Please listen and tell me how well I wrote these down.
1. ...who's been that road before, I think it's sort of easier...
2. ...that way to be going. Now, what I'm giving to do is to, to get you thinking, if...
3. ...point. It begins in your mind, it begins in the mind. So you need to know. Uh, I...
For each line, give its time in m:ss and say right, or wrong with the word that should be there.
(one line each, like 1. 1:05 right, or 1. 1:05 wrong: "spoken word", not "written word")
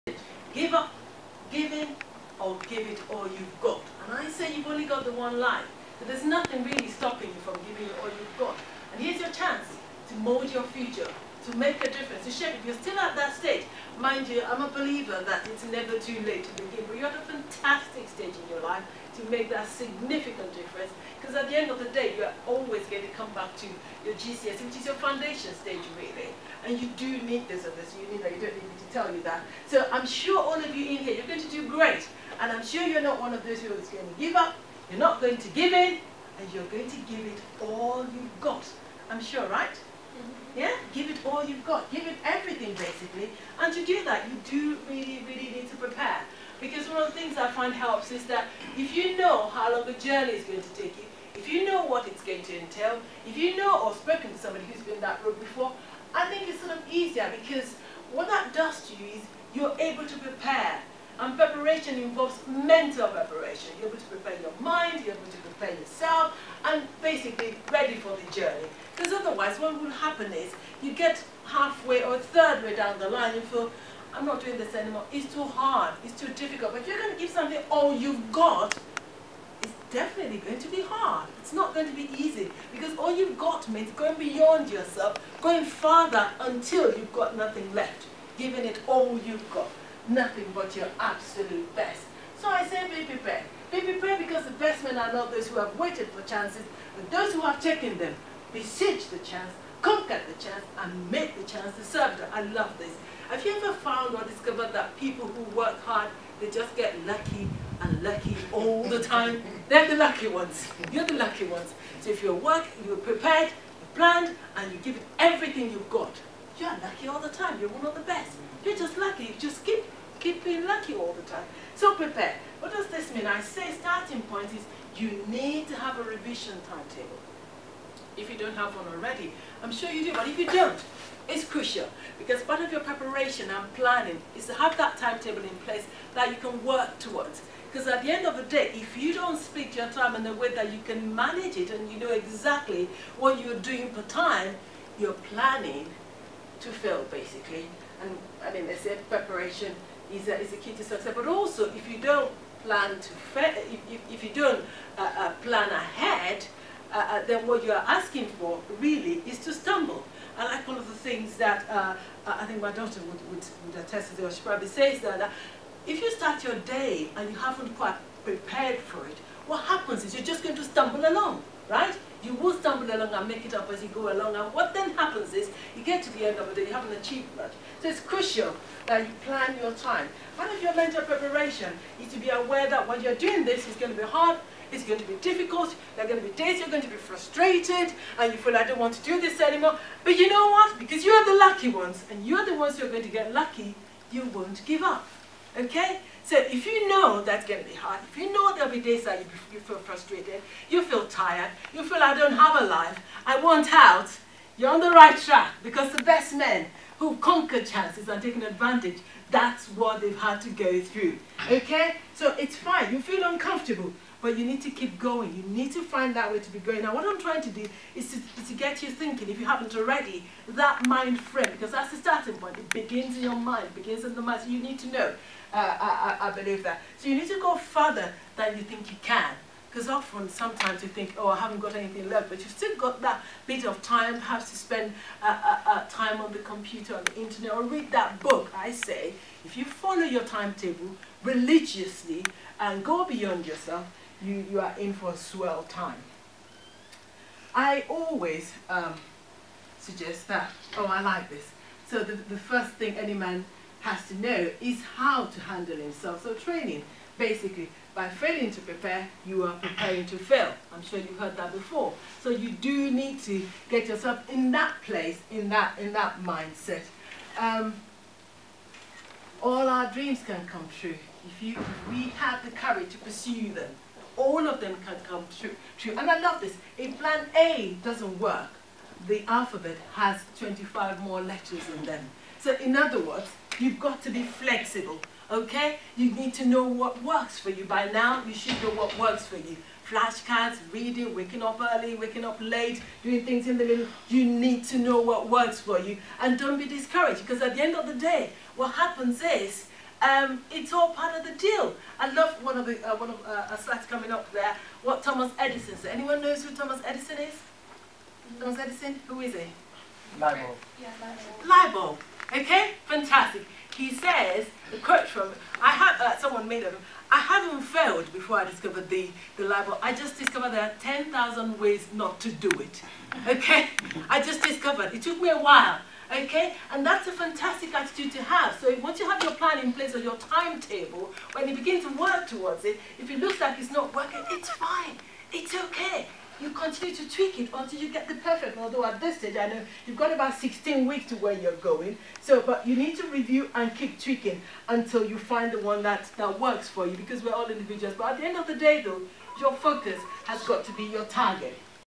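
1. 0:54 right
2. 3:36 wrong: "trying", not "giving"
3. 3:42 right.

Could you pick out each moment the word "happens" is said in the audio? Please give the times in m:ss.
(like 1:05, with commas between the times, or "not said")
1:09, 2:49, 2:54, 4:58.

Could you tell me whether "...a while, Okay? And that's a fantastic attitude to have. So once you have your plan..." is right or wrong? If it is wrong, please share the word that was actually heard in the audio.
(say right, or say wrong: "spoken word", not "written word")
right.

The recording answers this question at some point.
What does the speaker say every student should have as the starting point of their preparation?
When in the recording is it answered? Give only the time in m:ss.
2:06.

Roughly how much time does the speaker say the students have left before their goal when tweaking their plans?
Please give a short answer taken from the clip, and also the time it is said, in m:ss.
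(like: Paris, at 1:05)
16 weeks, at 5:40.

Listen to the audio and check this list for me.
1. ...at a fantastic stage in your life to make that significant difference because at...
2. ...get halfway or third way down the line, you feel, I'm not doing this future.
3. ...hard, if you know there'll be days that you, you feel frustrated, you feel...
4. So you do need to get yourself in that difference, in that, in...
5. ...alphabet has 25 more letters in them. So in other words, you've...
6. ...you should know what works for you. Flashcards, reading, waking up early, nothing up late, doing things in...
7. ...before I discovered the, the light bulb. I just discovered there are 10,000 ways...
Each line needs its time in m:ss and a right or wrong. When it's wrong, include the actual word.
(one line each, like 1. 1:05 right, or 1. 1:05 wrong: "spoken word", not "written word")
1. 0:17 right
2. 1:10 wrong: "anymore", not "future"
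3. 3:17 right
4. 4:22 wrong: "place", not "difference"
5. 4:39 right
6. 4:48 wrong: "waking", not "nothing"
7. 5:18 right.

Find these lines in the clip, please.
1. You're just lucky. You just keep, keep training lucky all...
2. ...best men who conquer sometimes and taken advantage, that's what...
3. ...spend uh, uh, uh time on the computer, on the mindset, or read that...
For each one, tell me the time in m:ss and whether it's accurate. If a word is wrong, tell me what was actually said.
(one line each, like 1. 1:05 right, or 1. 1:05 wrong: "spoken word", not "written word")
1. 1:58 wrong: "being", not "training"
2. 3:26 wrong: "chances", not "sometimes"
3. 3:54 wrong: "internet", not "mindset".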